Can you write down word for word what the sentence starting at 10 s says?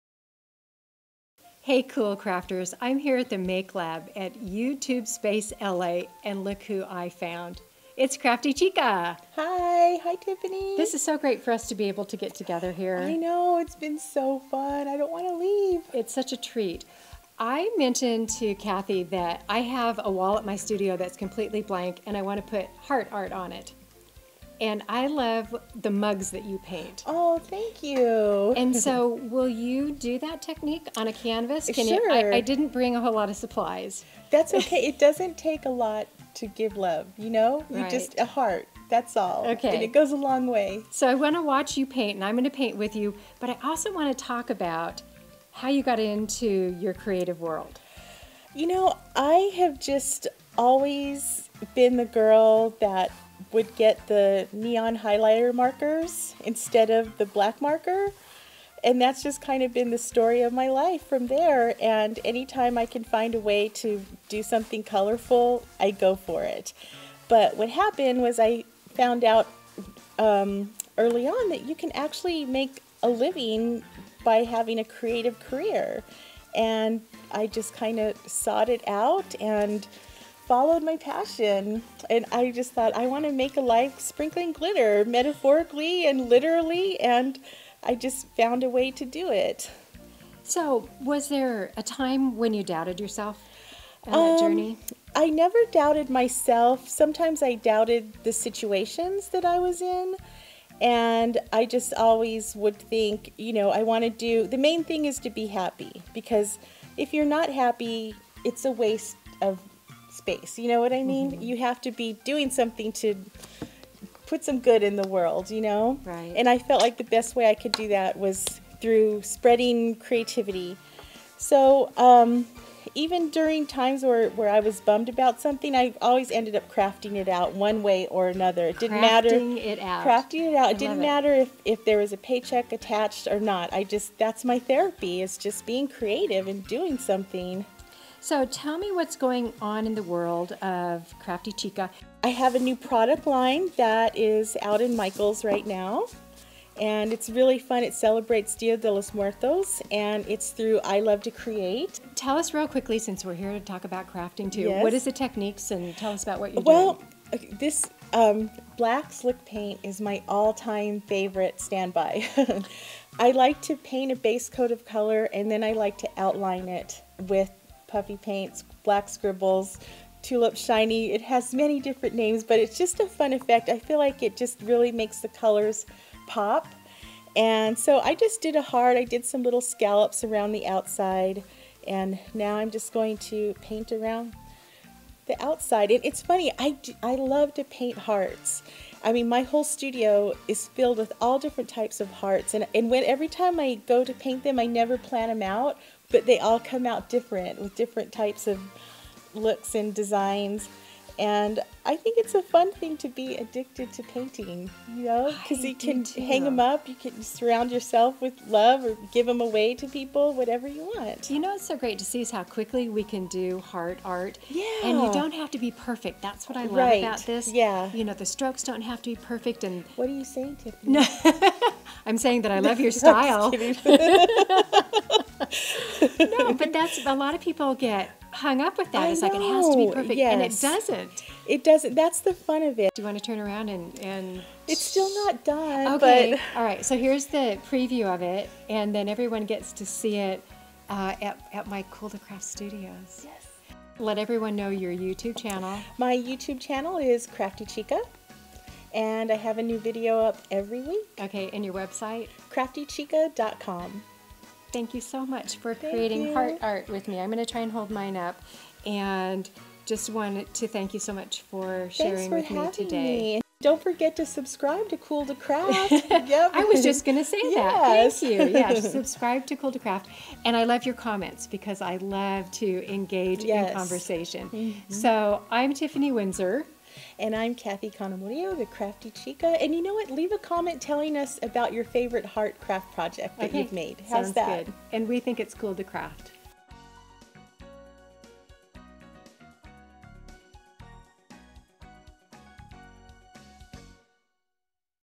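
This is so great for us to be able to get together here.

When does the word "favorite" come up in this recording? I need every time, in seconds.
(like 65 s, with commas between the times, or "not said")
161 s, 281 s.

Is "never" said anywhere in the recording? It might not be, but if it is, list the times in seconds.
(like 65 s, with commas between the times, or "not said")
95 s, 194 s.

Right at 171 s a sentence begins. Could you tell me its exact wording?
It has many different names, but it's just a fun effect.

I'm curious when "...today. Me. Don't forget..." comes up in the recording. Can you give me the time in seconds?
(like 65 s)
262 s.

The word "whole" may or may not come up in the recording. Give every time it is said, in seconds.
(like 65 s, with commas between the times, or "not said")
33 s, 189 s.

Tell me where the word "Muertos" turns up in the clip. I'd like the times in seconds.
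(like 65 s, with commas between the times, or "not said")
149 s.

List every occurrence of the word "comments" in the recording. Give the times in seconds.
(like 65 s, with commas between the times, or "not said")
270 s, 280 s.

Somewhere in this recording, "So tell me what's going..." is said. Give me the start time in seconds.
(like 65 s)
138 s.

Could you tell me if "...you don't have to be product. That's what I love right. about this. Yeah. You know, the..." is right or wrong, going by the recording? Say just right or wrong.
wrong.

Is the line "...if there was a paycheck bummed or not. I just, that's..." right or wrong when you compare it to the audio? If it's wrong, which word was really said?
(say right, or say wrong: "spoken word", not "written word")
wrong: "attached", not "bummed".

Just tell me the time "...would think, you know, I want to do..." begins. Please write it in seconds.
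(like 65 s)
102 s.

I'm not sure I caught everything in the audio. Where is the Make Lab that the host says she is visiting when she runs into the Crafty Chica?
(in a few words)
YouTube Space LA.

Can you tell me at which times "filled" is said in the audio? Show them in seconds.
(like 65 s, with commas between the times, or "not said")
190 s.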